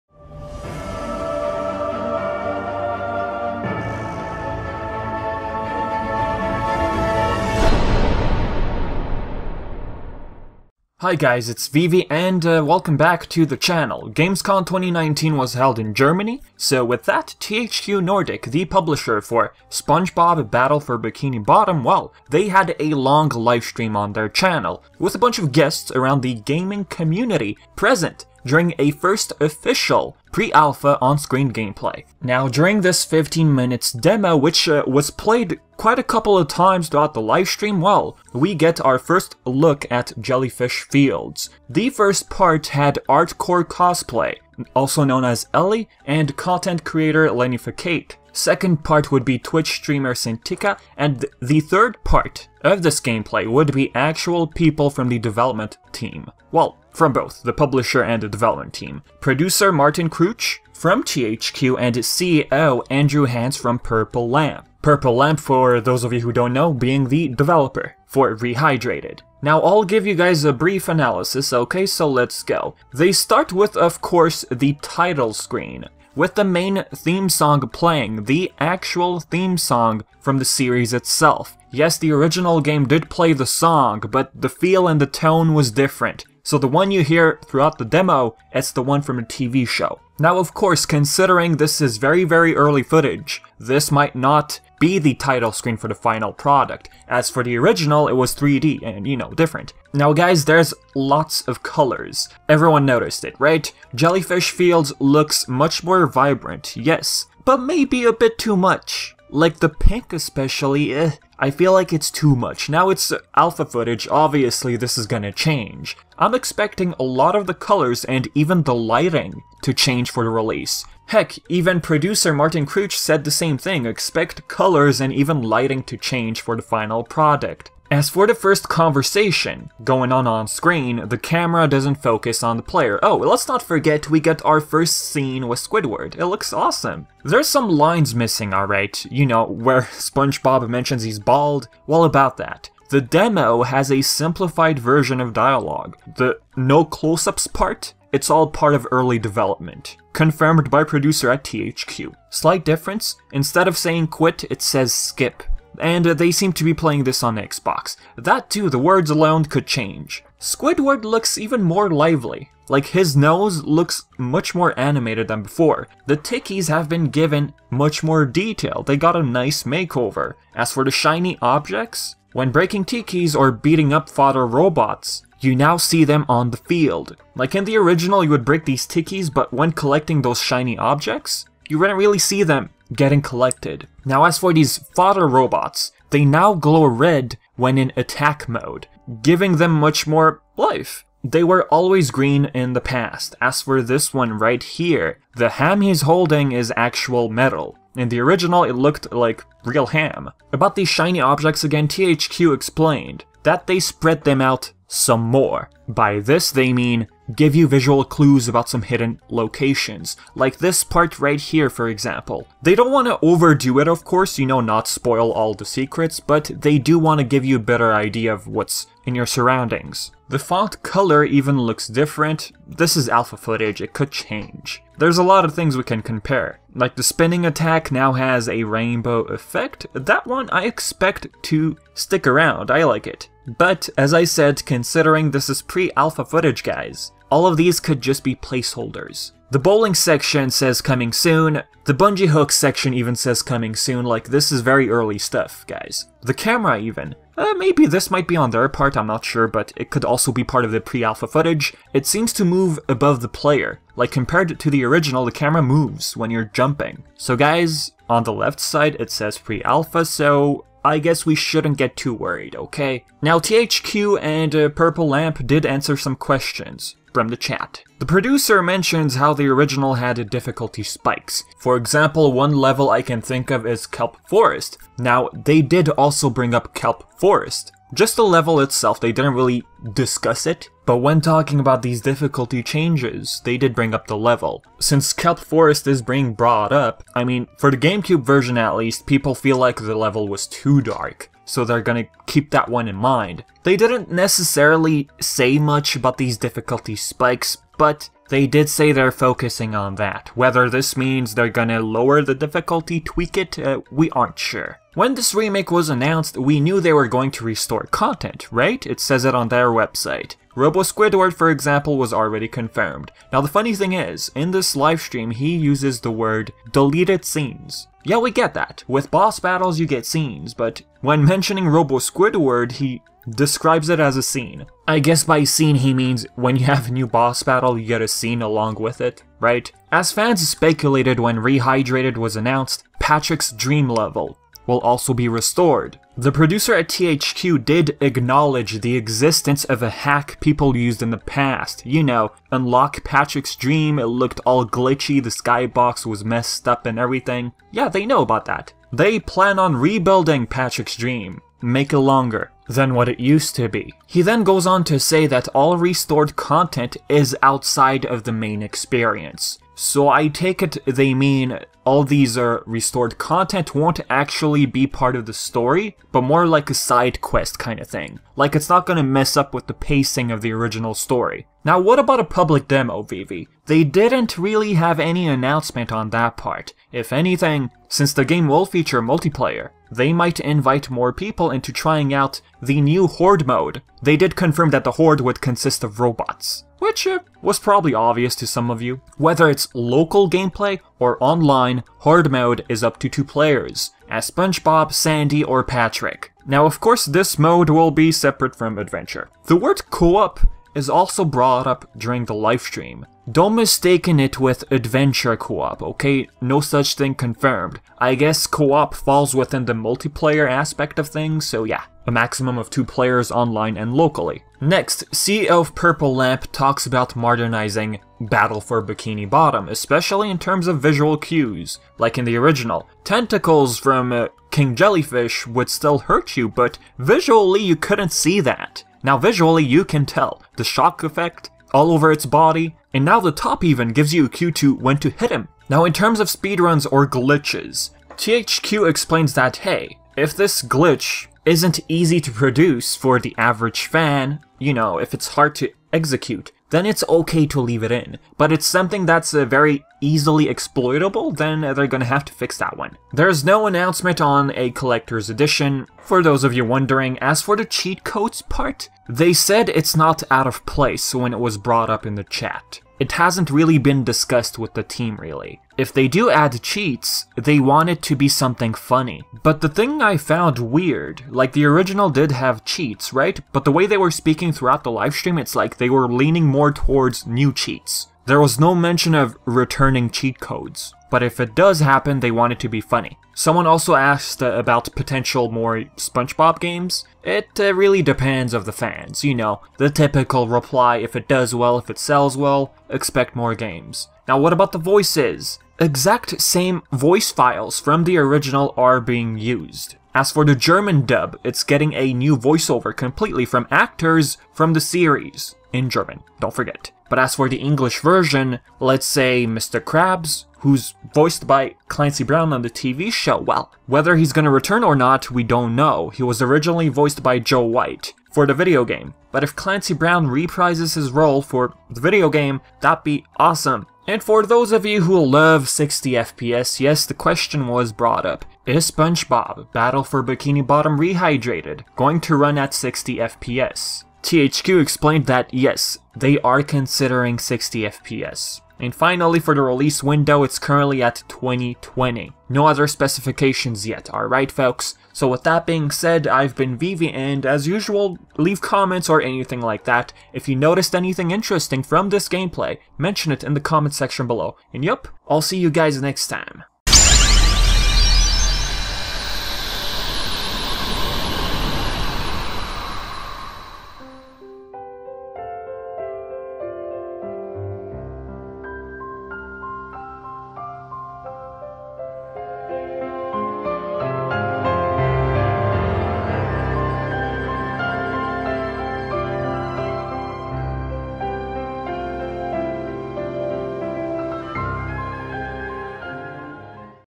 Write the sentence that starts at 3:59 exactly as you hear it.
The bowling section says coming soon, the bungee hook section even says coming soon, like this is very early stuff, guys.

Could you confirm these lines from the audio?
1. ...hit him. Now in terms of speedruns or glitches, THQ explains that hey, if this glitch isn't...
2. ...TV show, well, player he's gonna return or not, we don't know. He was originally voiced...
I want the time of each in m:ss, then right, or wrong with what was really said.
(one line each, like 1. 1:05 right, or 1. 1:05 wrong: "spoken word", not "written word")
1. 7:15 right
2. 8:32 wrong: "whether", not "player".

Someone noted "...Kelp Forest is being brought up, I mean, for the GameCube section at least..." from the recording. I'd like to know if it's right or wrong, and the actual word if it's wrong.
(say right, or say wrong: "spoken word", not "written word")
wrong: "version", not "section".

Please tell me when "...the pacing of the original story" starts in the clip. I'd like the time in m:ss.
6:09.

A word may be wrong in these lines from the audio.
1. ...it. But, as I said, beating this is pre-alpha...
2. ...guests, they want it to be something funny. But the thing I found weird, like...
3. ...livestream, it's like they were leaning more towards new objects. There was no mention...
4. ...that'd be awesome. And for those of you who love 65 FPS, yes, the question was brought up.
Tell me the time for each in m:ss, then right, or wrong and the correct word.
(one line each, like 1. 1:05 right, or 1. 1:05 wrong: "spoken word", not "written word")
1. 3:53 wrong: "considering", not "beating"
2. 7:46 wrong: "cheats", not "guests"
3. 7:54 wrong: "cheats", not "objects"
4. 8:42 wrong: "60", not "65".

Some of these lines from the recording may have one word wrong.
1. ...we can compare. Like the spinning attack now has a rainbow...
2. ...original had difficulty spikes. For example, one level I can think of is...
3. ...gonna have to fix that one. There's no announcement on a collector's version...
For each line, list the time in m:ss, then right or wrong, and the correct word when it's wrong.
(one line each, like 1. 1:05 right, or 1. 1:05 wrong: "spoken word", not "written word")
1. 3:45 right
2. 4:29 right
3. 7:31 wrong: "edition", not "version".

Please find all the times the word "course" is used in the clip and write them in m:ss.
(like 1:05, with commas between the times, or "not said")
1:14, 1:30, 3:34, 6:36.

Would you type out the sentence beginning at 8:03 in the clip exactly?
Someone also asked uh, about potential more SpongeBob games.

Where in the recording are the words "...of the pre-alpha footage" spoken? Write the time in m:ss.
4:10.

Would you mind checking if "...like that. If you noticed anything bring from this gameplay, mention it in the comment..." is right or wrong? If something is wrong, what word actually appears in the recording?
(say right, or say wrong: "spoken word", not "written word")
wrong: "interesting", not "bring".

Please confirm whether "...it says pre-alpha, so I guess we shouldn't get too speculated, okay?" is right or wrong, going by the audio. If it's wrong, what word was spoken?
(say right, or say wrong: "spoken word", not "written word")
wrong: "worried", not "speculated".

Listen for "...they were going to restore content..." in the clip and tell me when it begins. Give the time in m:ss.
5:06.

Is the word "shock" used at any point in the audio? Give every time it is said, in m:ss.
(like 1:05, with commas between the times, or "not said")
7:10.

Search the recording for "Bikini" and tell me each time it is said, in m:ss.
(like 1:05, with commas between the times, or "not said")
0:20, 6:58, 8:50.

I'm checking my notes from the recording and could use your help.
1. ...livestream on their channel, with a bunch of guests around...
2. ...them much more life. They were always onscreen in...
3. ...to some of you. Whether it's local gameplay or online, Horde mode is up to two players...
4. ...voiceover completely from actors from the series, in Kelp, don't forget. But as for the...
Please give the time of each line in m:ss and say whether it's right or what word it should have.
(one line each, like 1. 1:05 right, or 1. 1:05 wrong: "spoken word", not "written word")
1. 0:23 right
2. 3:09 wrong: "green", not "onscreen"
3. 6:28 right
4. 8:22 wrong: "German", not "Kelp".